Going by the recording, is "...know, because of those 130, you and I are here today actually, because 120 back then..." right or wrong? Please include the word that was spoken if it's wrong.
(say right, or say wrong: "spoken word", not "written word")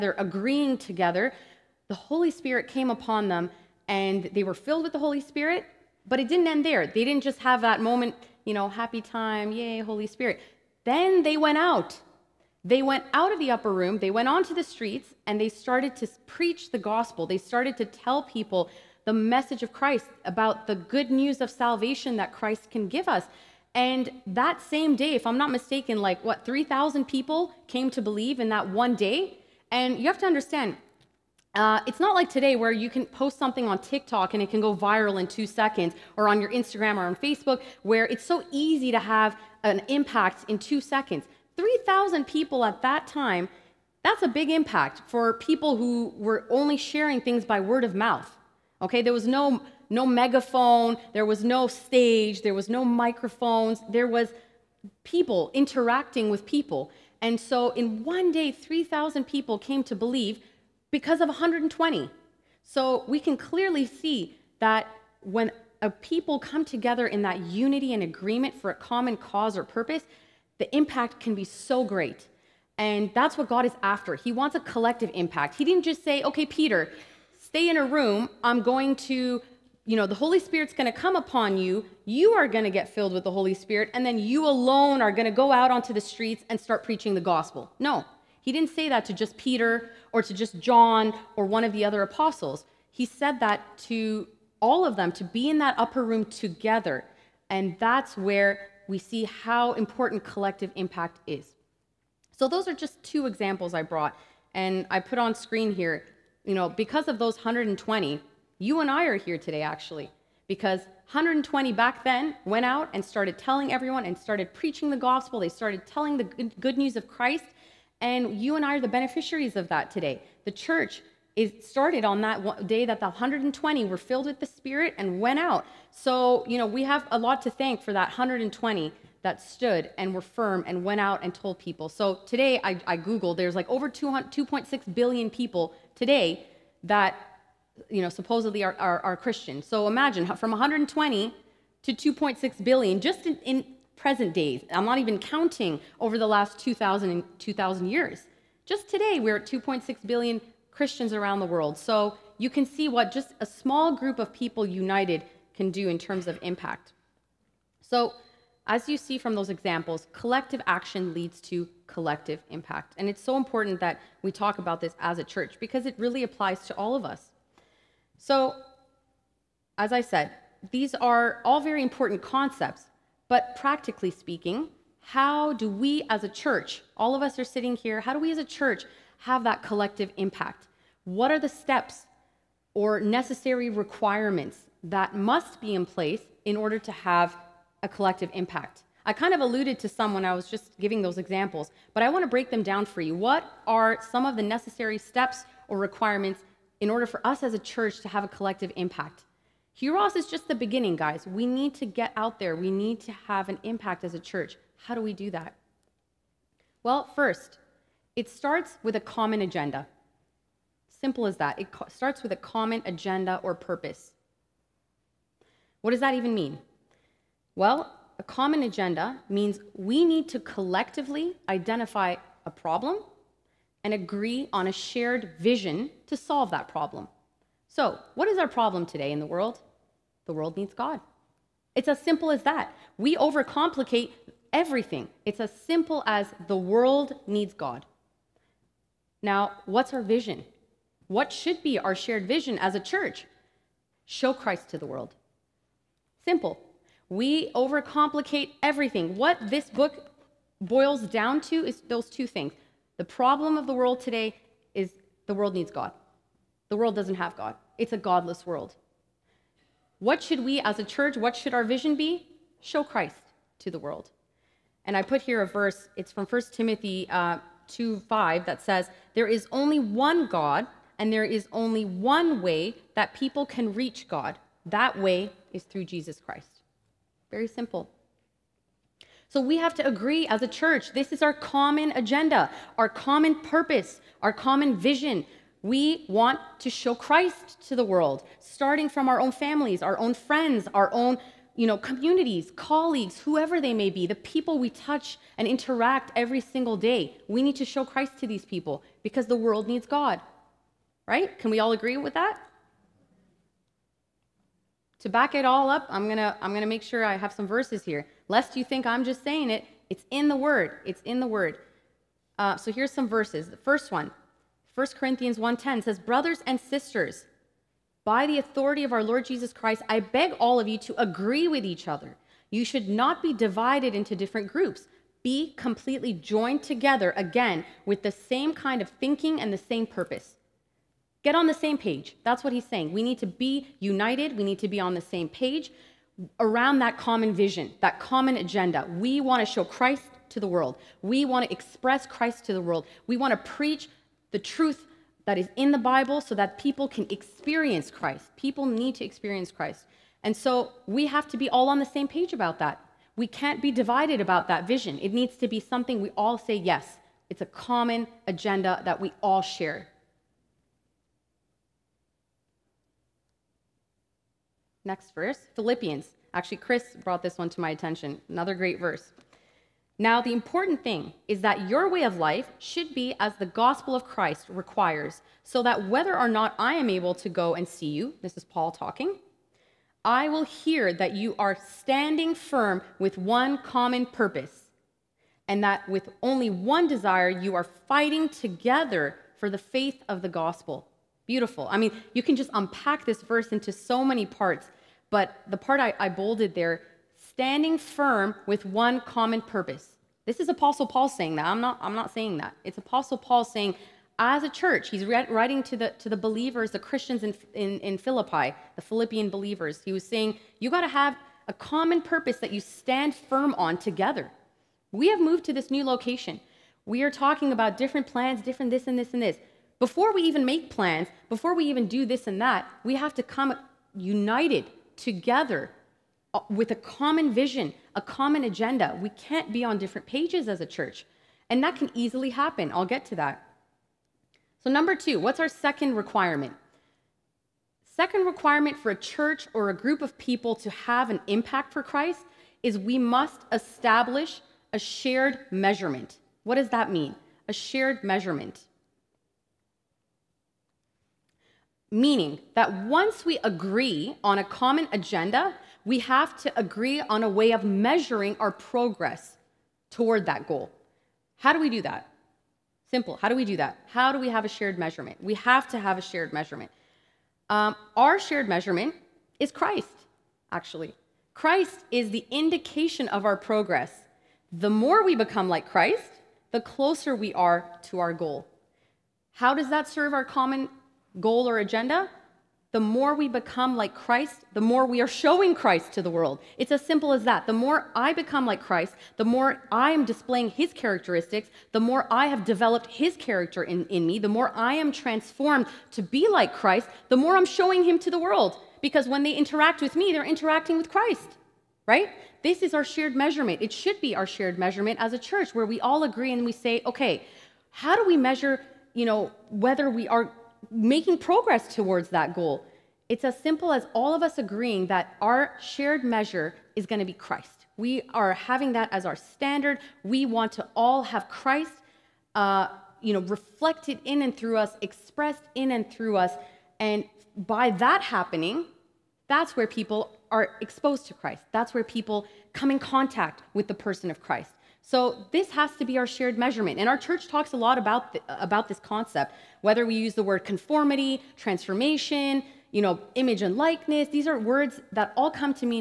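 wrong: "120", not "130".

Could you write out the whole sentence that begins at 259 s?
What should we as a church, what should our vision be?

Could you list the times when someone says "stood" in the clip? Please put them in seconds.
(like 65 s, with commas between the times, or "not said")
129 s.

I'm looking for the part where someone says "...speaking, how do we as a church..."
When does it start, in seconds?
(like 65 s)
174 s.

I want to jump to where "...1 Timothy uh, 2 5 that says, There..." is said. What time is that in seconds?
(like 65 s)
266 s.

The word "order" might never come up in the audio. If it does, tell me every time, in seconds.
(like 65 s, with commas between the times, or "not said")
186 s, 196 s.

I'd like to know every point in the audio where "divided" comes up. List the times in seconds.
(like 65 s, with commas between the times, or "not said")
323 s, 353 s.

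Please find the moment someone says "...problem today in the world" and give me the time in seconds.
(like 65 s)
228 s.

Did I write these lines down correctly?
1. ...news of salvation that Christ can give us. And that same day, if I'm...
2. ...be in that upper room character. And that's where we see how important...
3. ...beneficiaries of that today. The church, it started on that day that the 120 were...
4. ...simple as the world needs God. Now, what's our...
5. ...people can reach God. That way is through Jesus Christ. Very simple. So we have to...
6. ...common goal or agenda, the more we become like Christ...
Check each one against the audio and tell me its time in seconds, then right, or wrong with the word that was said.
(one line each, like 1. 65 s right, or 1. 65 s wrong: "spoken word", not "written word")
1. 21 s right
2. 95 s wrong: "together", not "character"
3. 118 s right
4. 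235 s right
5. 273 s right
6. 480 s right.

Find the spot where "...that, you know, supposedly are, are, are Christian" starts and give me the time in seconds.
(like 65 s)
136 s.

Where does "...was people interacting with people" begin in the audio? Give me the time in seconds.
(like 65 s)
54 s.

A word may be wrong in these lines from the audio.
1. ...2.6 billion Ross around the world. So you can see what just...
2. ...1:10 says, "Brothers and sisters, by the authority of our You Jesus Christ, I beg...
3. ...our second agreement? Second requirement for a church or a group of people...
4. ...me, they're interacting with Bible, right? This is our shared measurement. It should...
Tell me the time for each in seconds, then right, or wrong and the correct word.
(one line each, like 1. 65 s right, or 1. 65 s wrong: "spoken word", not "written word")
1. 149 s wrong: "Christians", not "Ross"
2. 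315 s wrong: "Lord", not "You"
3. 435 s wrong: "requirement", not "agreement"
4. 499 s wrong: "Christ", not "Bible".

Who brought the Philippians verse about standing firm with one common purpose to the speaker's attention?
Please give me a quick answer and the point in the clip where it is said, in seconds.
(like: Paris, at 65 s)
Chris, at 366 s.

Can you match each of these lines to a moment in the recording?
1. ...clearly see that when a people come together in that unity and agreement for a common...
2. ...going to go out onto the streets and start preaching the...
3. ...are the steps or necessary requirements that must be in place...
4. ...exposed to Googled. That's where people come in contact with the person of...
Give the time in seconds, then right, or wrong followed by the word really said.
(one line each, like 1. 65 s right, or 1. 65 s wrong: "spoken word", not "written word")
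1. 63 s right
2. 85 s right
3. 181 s right
4. 530 s wrong: "Christ", not "Googled".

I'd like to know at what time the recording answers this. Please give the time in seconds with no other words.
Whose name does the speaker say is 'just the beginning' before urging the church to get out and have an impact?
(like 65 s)
199 s.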